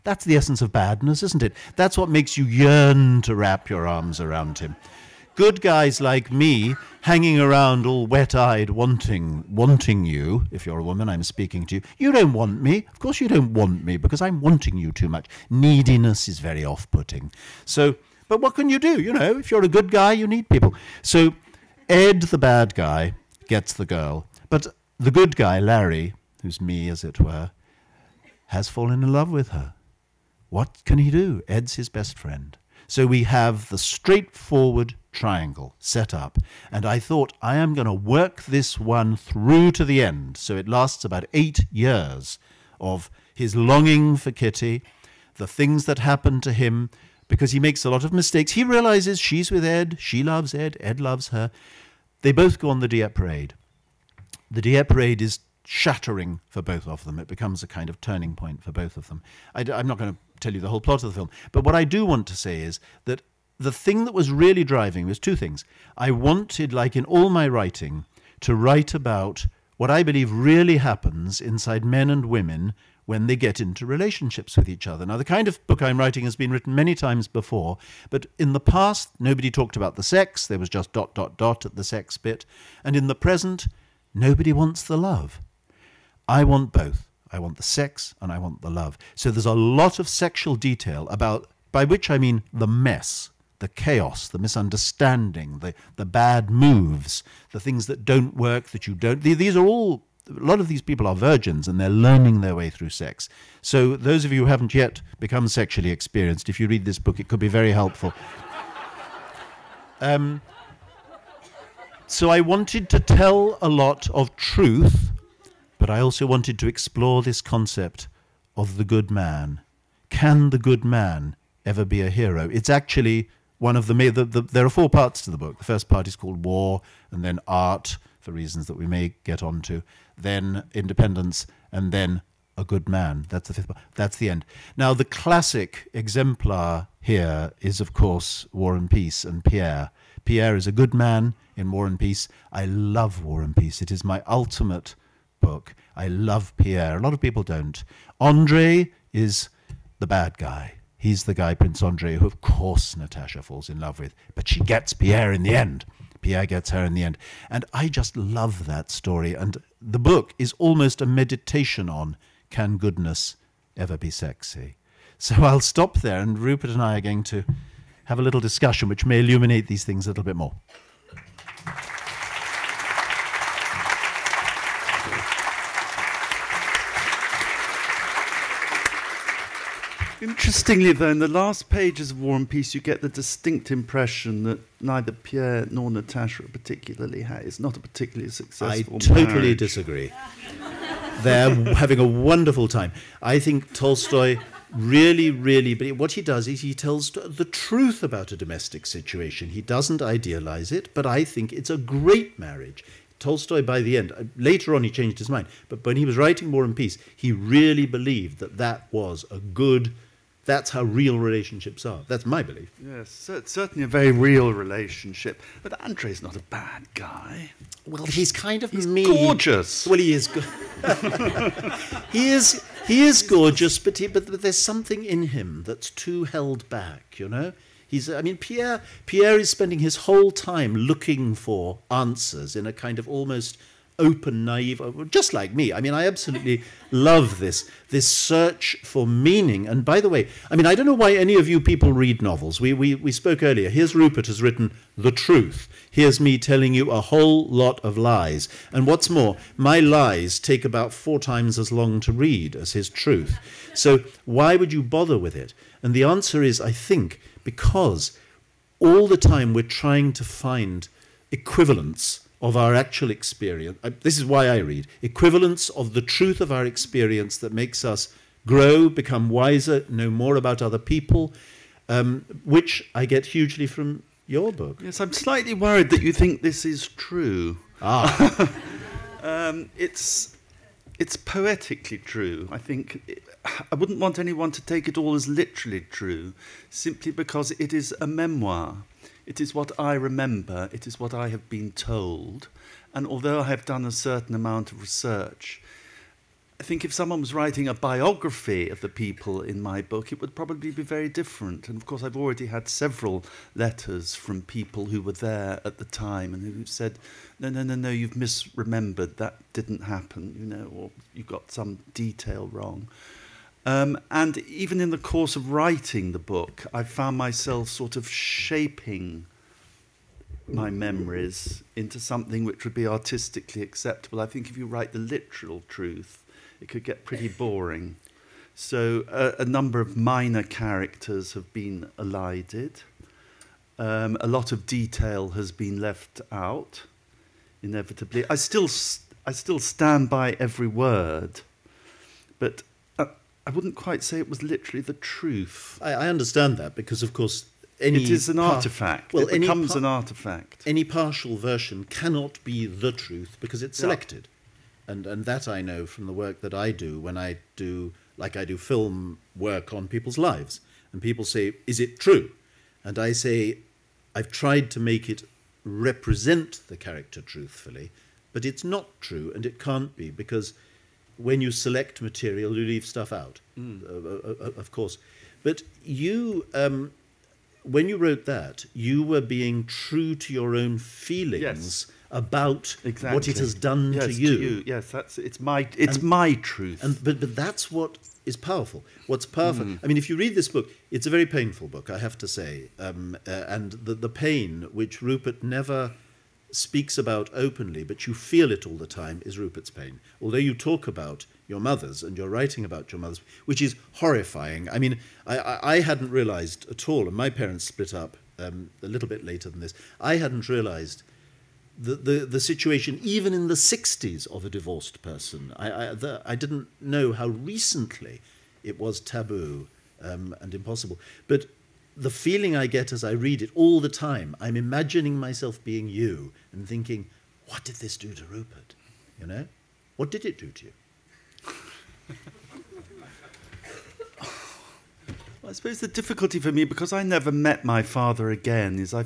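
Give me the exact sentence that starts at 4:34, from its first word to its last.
Yes, I'm slightly worried that you think this is true.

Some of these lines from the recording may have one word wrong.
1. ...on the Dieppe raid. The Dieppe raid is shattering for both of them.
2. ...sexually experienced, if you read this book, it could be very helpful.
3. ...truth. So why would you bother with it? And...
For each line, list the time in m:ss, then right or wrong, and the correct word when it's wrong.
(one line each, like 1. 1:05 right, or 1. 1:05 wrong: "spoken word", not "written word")
1. 0:52 right
2. 1:45 right
3. 4:12 right.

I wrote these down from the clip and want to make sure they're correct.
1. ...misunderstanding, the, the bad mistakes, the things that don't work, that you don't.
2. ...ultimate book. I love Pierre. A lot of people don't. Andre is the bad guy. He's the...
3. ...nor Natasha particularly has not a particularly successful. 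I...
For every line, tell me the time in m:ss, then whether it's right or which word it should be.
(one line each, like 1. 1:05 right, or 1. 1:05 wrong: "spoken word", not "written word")
1. 1:34 wrong: "moves", not "mistakes"
2. 2:24 right
3. 3:05 right.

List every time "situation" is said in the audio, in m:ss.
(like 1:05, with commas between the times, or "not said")
3:18, 6:52.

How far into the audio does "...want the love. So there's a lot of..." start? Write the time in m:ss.
1:28.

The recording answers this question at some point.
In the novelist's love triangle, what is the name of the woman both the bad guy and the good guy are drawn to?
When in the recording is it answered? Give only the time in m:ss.
0:44.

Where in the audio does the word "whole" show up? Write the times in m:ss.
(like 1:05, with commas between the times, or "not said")
1:00, 3:49, 4:07.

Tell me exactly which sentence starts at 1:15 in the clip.
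Now, the kind of book I'm writing has been written many times before, but in the past, nobody talked about the sex.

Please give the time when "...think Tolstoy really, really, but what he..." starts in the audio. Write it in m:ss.
3:13.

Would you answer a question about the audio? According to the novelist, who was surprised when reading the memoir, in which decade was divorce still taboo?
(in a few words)
1960s.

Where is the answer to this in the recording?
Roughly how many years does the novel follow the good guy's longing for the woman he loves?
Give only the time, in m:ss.
0:41.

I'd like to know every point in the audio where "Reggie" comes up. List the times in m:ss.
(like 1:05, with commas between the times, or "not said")
not said.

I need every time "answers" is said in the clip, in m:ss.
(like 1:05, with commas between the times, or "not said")
3:51, 4:16.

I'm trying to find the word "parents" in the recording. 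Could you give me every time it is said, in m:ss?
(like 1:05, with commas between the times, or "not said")
6:47.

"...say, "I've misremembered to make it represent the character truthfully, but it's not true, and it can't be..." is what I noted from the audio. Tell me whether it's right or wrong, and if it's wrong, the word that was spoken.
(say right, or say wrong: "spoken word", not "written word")
wrong: "tried", not "misremembered".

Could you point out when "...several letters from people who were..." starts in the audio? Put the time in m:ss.
5:02.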